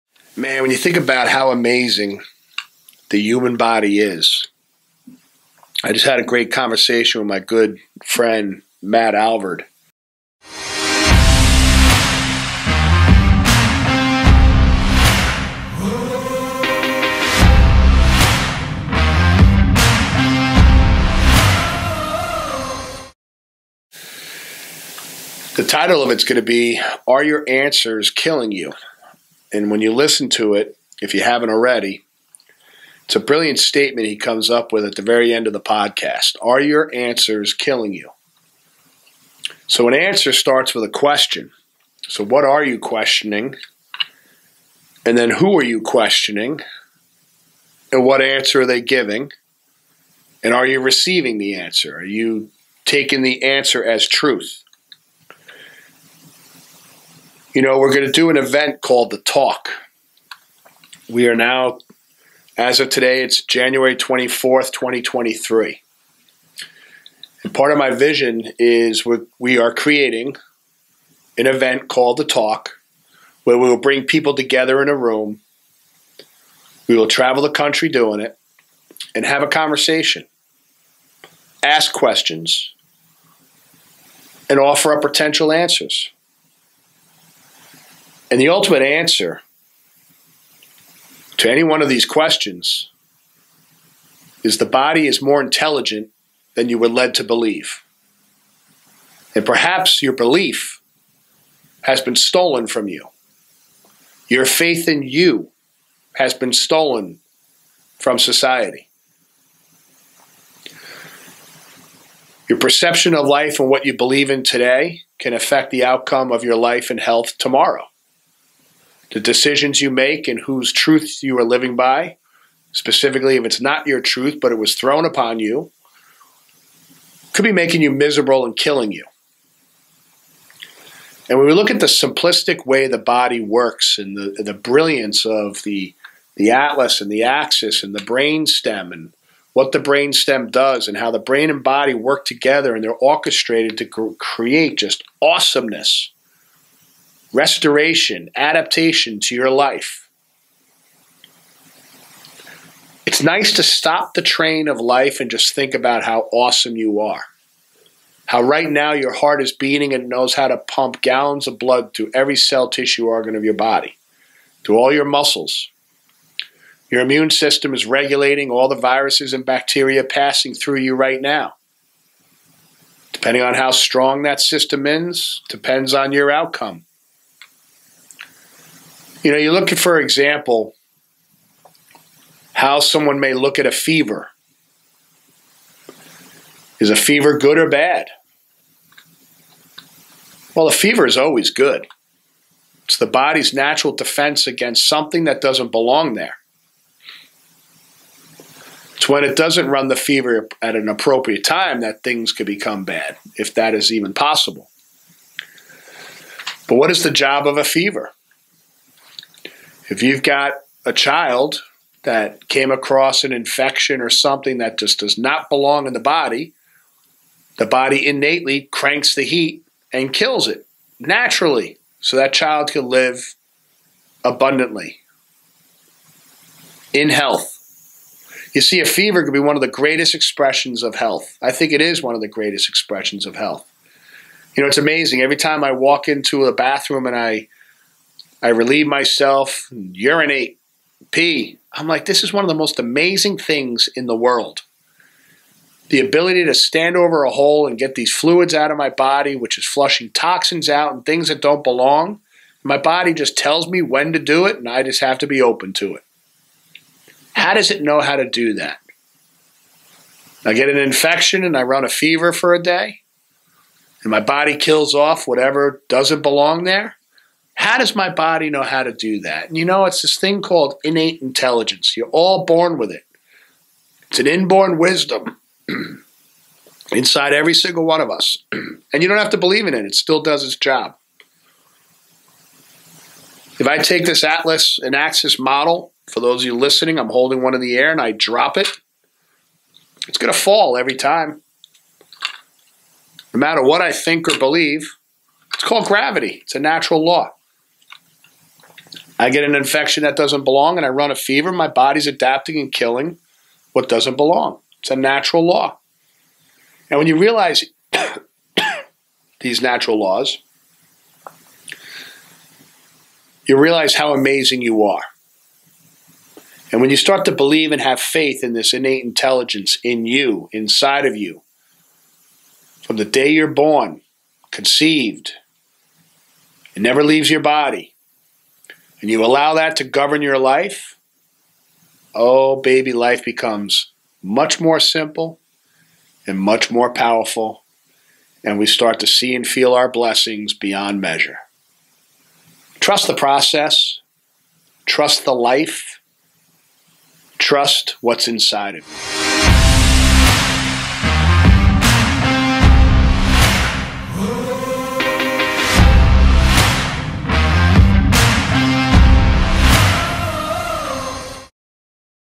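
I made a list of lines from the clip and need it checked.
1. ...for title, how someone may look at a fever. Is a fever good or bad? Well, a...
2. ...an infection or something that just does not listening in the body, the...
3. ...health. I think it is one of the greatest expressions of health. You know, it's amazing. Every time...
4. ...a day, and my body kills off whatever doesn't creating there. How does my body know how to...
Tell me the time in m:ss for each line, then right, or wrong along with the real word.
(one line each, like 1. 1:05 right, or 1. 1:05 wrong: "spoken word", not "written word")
1. 2:59 wrong: "example", not "title"
2. 3:33 wrong: "belong", not "listening"
3. 3:50 right
4. 4:22 wrong: "belong", not "creating".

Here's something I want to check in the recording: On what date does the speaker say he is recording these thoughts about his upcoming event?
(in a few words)
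January 24th, 2023.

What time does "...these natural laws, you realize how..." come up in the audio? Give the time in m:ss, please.
5:09.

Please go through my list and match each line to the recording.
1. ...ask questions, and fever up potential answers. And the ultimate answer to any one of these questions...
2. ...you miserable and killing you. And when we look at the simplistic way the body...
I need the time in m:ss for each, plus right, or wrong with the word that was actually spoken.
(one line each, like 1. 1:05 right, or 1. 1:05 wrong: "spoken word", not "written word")
1. 1:21 wrong: "offer", not "fever"
2. 2:07 right.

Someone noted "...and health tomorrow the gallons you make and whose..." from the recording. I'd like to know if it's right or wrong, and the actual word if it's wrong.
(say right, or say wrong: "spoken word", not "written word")
wrong: "decisions", not "gallons".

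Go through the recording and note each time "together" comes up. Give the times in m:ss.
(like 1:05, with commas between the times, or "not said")
1:14, 2:22.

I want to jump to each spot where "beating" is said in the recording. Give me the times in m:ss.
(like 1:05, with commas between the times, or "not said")
2:39.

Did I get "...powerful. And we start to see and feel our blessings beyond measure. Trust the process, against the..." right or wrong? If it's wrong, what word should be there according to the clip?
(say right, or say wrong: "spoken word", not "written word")
wrong: "trust", not "against".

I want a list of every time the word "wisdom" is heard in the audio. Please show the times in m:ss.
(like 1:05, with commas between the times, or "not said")
4:34.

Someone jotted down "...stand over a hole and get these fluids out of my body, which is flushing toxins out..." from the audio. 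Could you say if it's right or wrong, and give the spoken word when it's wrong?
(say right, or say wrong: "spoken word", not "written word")
right.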